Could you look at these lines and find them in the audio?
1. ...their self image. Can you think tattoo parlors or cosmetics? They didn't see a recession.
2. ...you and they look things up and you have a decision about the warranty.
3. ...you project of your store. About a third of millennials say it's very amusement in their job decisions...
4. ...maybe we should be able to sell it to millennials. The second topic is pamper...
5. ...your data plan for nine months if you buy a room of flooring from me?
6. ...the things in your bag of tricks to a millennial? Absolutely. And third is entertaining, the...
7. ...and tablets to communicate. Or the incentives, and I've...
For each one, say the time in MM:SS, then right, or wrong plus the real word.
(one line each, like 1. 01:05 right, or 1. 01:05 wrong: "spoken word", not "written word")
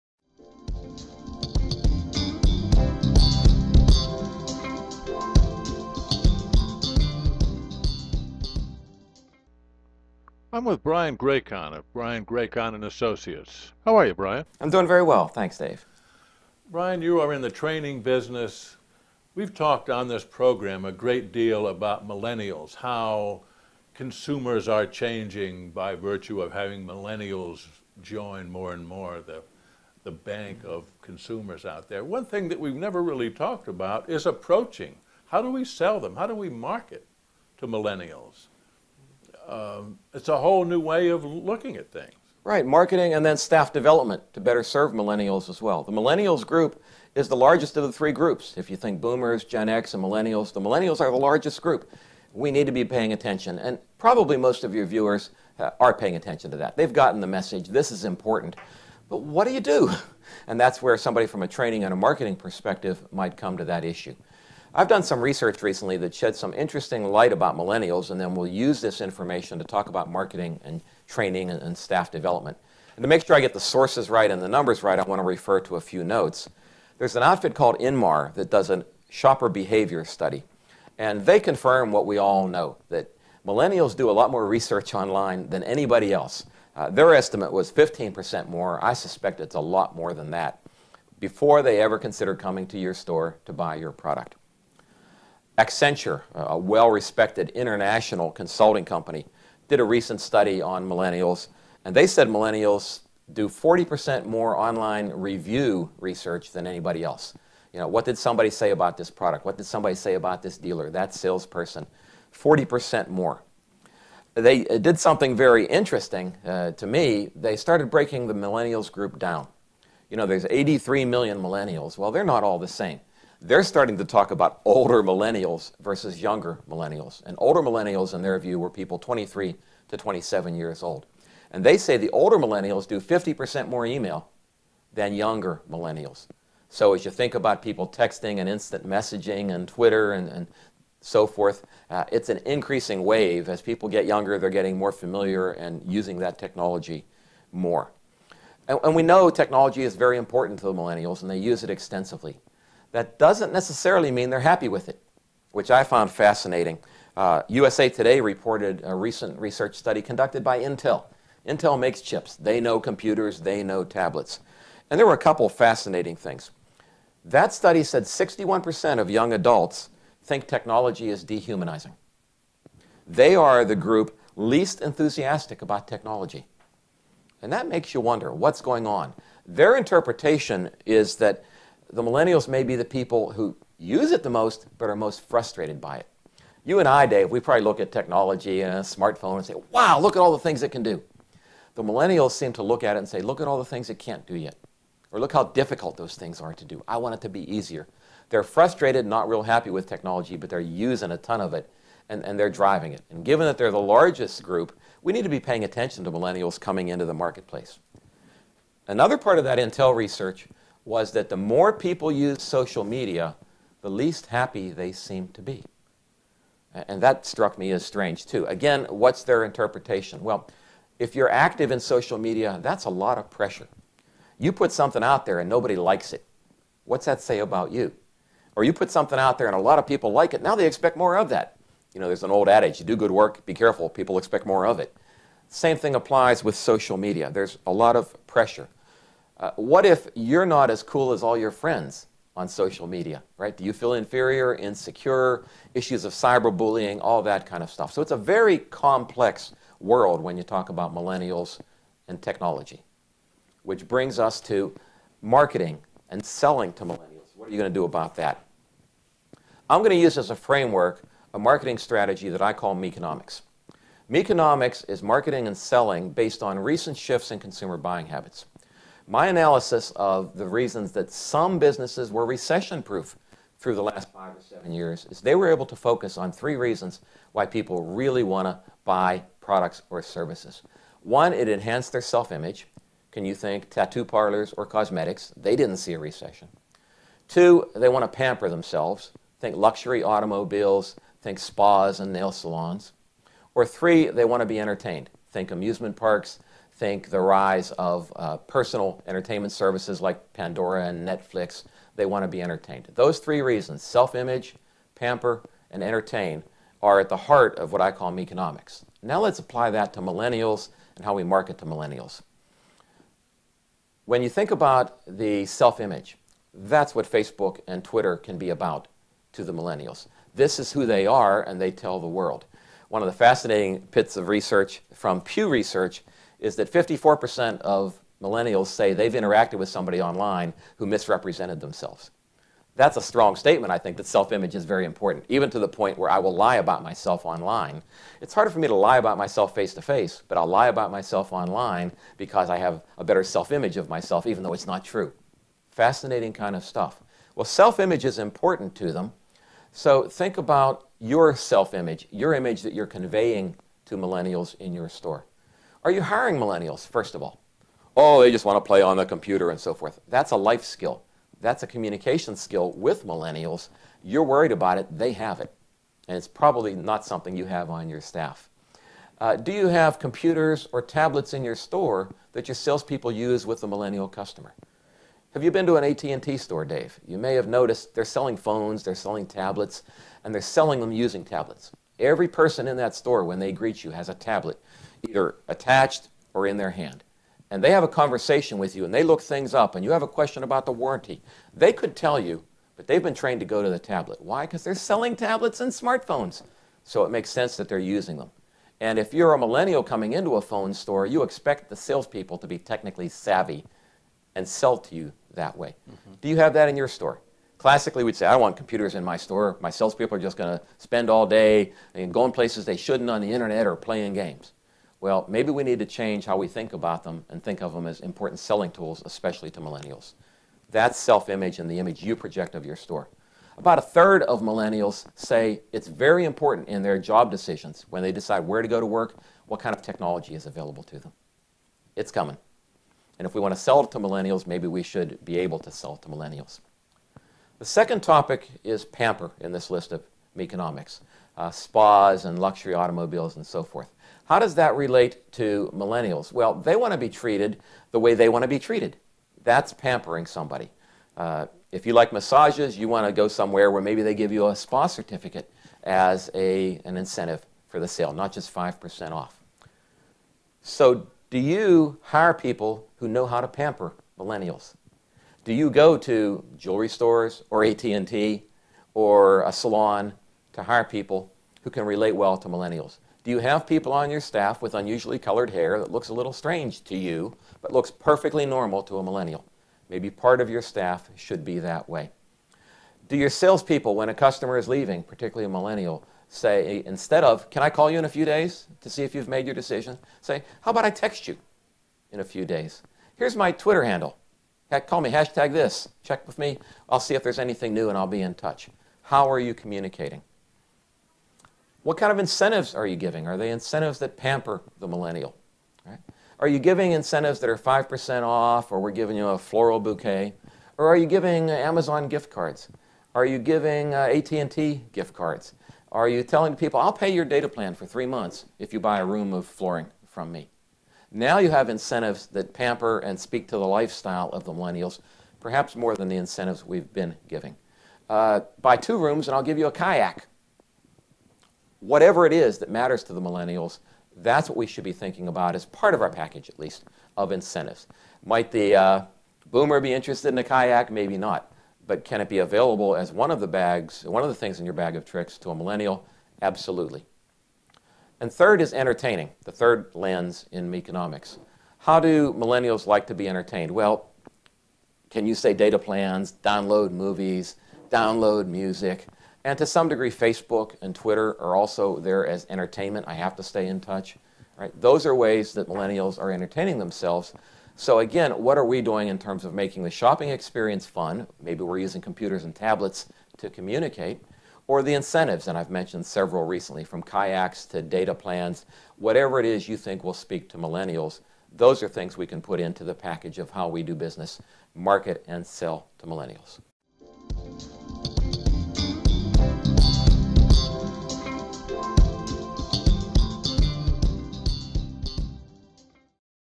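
1. 04:41 right
2. 06:28 wrong: "question", not "decision"
3. 07:02 wrong: "important", not "amusement"
4. 07:14 right
5. 08:37 wrong: "three", not "nine"
6. 09:04 right
7. 09:32 right.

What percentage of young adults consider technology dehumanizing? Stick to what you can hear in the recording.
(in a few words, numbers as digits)
61%.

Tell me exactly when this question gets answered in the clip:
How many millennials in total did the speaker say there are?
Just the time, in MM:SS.
02:00.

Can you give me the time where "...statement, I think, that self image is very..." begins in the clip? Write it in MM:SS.
05:33.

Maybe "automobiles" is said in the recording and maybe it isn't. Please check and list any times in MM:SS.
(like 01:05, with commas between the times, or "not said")
04:50, 07:22.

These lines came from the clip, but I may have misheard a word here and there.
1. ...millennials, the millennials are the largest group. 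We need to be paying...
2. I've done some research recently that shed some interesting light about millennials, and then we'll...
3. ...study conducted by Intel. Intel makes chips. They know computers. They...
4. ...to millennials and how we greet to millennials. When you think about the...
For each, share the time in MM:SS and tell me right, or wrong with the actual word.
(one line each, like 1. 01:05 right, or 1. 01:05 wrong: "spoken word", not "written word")
1. 00:50 right
2. 01:04 right
3. 02:39 right
4. 05:09 wrong: "market", not "greet".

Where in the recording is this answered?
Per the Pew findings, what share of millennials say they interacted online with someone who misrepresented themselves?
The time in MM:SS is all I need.
05:26.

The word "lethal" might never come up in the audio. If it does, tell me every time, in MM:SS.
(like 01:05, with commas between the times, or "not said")
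not said.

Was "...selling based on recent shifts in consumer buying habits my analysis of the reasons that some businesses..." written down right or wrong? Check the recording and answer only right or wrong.
right.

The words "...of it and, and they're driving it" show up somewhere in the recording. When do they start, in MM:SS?
03:21.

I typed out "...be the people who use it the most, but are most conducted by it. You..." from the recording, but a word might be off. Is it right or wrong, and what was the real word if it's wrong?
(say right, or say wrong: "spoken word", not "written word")
wrong: "frustrated", not "conducted".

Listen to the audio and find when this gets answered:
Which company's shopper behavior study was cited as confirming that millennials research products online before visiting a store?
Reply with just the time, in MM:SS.
01:17.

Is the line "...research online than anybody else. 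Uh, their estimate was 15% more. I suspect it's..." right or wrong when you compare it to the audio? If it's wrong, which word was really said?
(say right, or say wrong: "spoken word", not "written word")
right.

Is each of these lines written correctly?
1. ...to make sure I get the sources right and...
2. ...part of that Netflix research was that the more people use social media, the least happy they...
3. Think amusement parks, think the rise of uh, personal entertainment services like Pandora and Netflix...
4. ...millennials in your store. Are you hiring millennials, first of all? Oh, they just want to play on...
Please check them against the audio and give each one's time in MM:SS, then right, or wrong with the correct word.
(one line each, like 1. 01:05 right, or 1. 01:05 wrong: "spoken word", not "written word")
1. 01:13 right
2. 03:29 wrong: "Intel", not "Netflix"
3. 04:55 right
4. 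05:53 right.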